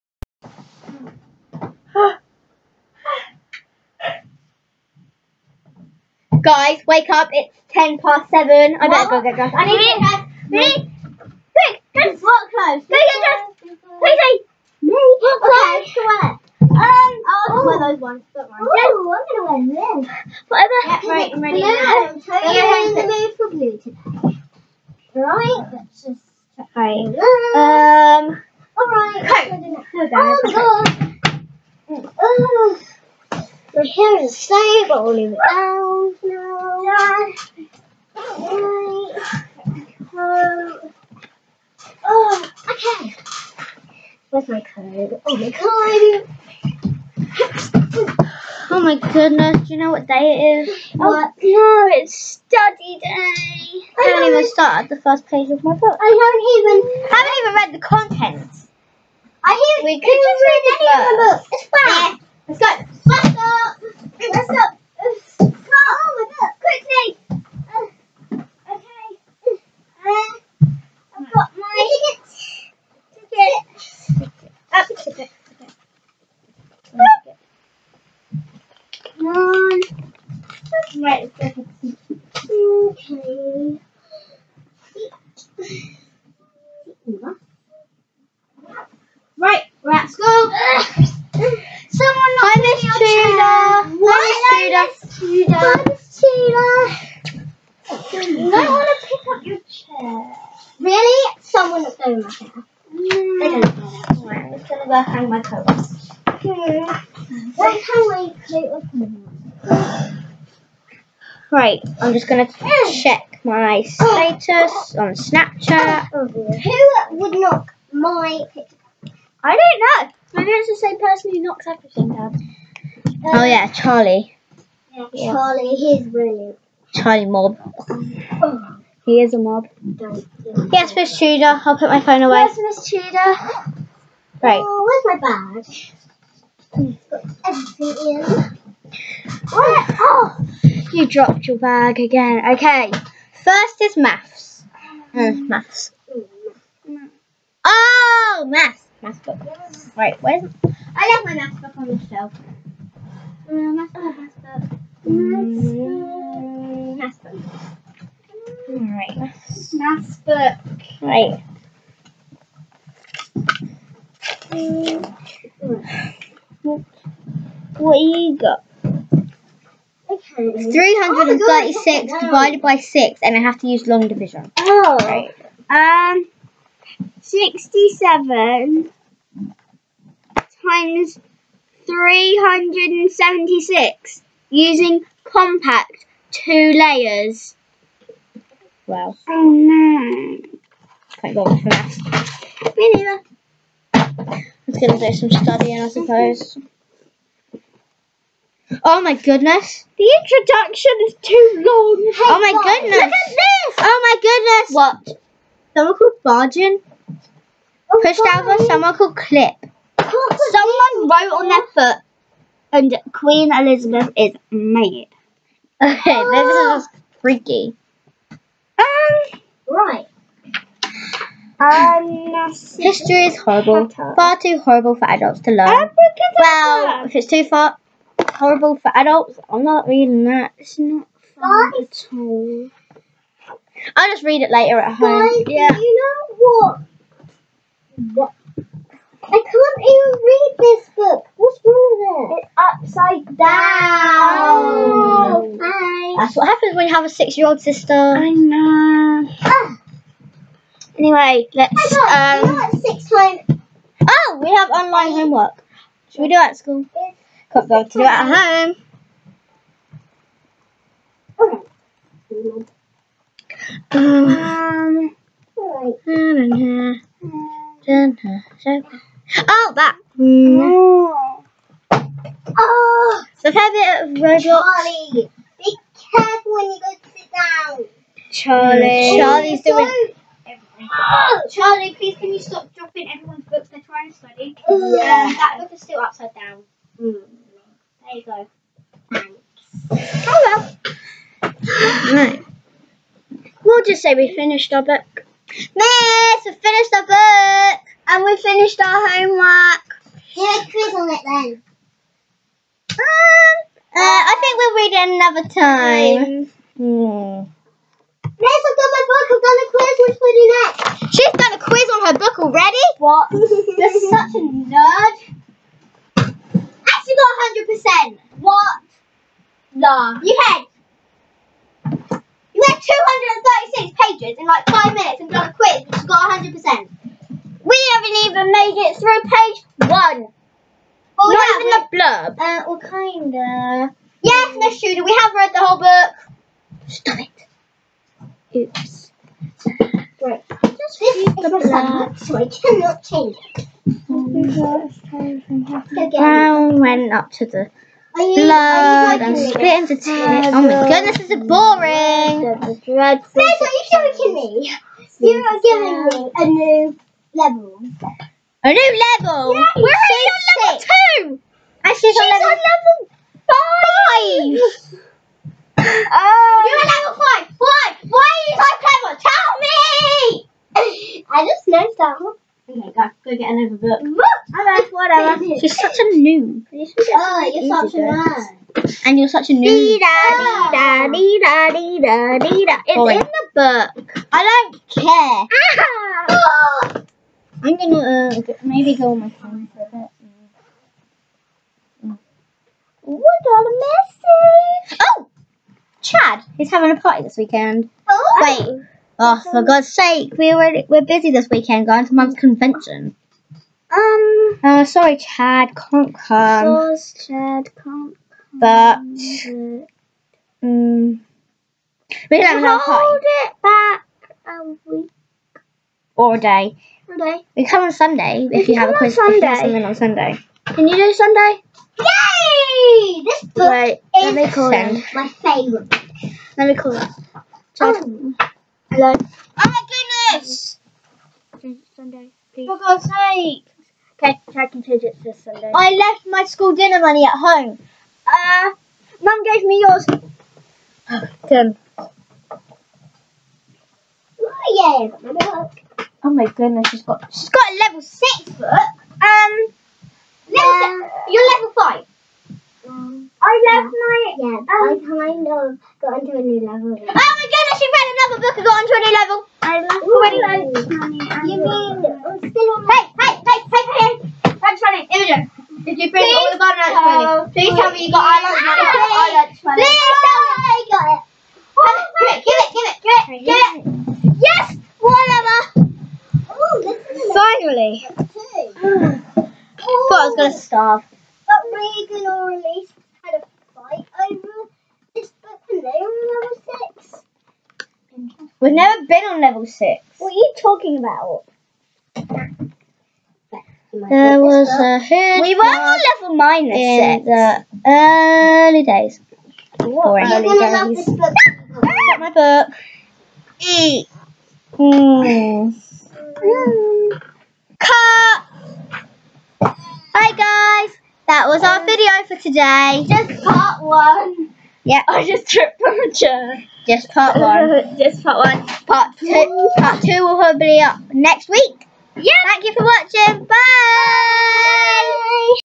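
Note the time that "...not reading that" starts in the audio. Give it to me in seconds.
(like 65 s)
229 s.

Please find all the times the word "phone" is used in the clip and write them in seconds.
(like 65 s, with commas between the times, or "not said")
131 s, 389 s.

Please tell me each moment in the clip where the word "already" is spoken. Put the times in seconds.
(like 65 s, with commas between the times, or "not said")
312 s, 400 s, 460 s.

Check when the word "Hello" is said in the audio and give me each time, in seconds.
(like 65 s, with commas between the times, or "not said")
290 s, 428 s.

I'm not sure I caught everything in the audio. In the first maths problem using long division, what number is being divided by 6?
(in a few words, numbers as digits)
336.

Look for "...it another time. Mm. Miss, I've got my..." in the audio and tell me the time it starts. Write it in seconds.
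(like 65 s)
304 s.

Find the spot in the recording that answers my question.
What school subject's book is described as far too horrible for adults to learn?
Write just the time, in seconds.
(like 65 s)
222 s.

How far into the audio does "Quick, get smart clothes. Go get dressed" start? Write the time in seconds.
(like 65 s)
11 s.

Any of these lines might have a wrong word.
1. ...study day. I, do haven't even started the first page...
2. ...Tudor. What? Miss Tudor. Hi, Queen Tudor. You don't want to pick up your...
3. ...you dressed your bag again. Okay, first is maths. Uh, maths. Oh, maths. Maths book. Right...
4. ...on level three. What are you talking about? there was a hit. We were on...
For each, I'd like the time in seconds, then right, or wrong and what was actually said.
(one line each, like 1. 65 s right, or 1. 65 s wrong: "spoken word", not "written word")
1. 52 s right
2. 92 s wrong: "Miss", not "Queen"
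3. 140 s wrong: "dropped", not "dressed"
4. 489 s wrong: "six", not "three".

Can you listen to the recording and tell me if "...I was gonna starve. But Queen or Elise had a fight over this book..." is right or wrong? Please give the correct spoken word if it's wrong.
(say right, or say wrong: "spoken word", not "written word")
wrong: "Regan", not "Queen".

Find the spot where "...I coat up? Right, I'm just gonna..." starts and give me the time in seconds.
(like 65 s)
108 s.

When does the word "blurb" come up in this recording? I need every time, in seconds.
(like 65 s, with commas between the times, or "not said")
331 s, 341 s.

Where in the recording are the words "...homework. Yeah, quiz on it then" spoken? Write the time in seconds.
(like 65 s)
299 s.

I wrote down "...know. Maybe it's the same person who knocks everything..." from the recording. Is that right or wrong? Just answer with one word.
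right.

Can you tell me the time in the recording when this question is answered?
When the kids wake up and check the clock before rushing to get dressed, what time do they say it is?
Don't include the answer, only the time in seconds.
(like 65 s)
7 s.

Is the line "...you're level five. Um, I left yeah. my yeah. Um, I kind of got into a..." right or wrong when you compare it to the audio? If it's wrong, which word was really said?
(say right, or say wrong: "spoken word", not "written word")
right.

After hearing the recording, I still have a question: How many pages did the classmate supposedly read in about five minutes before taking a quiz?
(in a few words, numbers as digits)
236.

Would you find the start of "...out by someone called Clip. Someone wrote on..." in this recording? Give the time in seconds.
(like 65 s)
208 s.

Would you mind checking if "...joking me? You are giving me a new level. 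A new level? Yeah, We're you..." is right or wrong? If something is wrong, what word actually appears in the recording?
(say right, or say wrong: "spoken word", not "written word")
right.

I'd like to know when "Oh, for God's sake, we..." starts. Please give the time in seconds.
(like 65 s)
399 s.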